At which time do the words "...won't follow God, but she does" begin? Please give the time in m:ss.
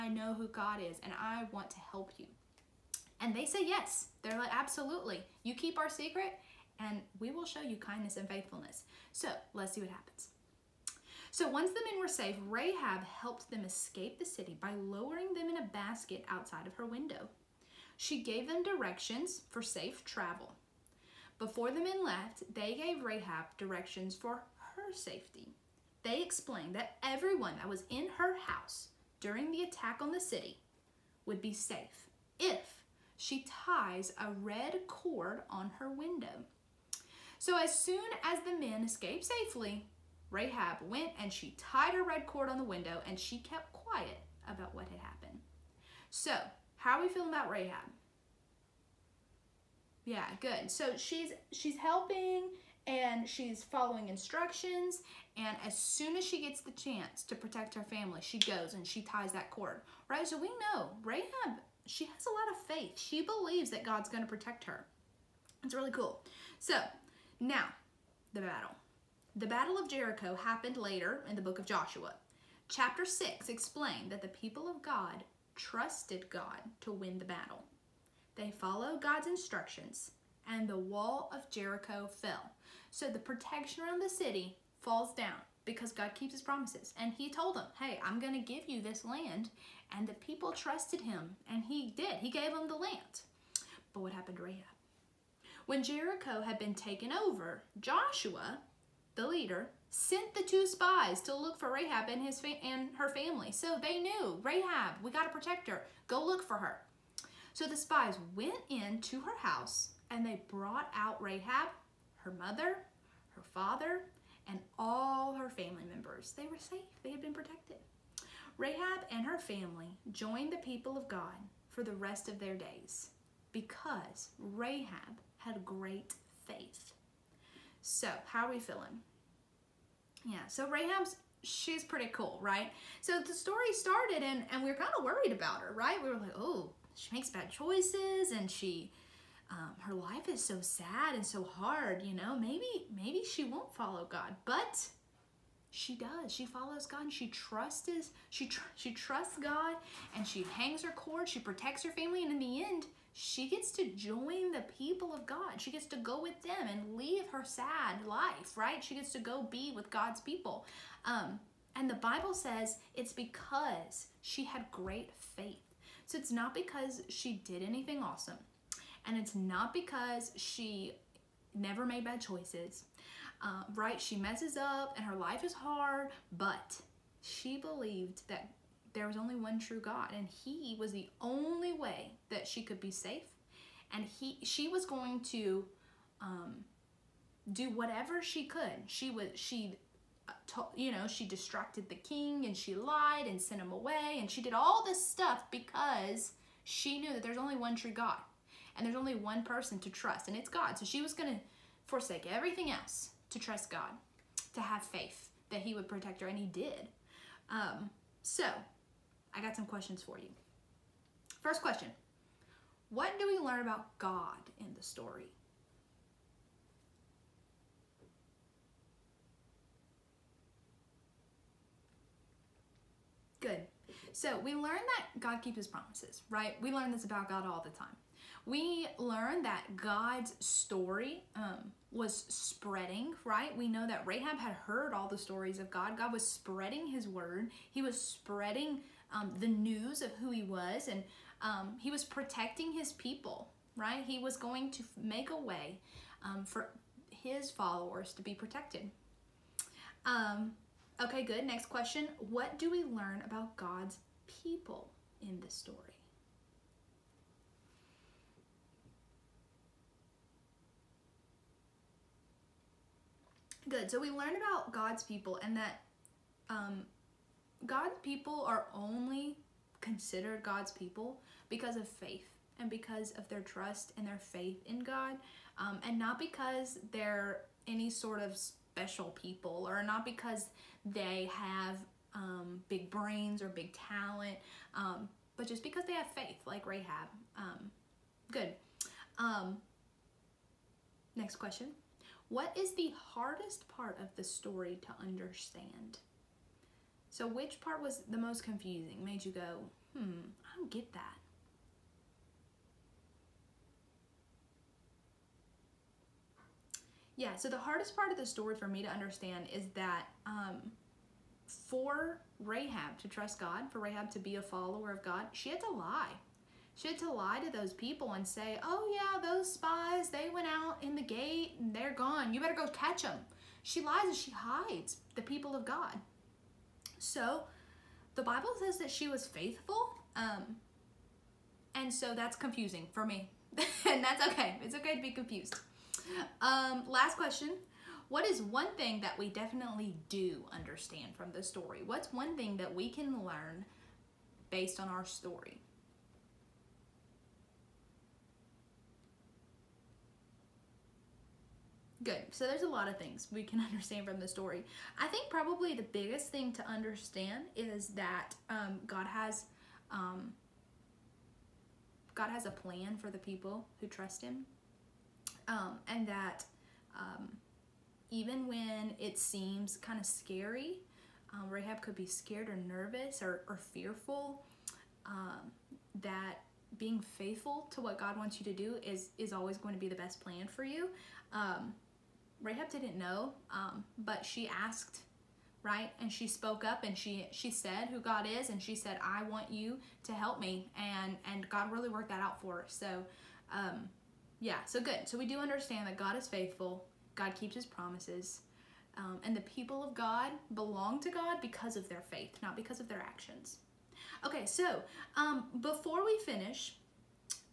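2:23.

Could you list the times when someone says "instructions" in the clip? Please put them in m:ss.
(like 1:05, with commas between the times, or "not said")
0:54, 1:19.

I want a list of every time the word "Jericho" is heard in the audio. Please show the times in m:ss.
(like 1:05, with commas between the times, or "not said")
1:09, 1:21, 1:35.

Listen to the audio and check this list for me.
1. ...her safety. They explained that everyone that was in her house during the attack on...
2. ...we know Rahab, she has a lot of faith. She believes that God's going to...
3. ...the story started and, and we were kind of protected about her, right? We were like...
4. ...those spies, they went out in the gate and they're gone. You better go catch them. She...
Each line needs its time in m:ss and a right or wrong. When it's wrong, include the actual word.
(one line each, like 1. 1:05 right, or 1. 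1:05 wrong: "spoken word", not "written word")
1. 0:24 right
2. 1:00 right
3. 2:13 wrong: "worried", not "protected"
4. 5:19 right.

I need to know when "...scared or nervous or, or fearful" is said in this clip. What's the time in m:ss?
6:12.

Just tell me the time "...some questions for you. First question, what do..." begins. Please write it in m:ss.
3:29.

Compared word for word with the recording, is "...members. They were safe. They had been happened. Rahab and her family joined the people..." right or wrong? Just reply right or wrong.
wrong.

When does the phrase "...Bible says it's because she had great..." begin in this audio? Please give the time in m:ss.
2:41.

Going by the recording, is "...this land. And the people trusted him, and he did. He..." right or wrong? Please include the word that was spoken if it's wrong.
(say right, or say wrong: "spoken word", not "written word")
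right.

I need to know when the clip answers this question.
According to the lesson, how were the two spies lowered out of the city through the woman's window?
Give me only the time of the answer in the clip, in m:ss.
0:15.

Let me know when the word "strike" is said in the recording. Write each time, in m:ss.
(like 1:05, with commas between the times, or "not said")
not said.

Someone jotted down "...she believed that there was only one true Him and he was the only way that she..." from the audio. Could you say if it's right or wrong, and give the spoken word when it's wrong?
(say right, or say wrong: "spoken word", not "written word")
wrong: "God", not "Him".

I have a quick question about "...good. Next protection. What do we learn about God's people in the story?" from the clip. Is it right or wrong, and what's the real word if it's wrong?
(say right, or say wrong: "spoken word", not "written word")
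wrong: "question", not "protection".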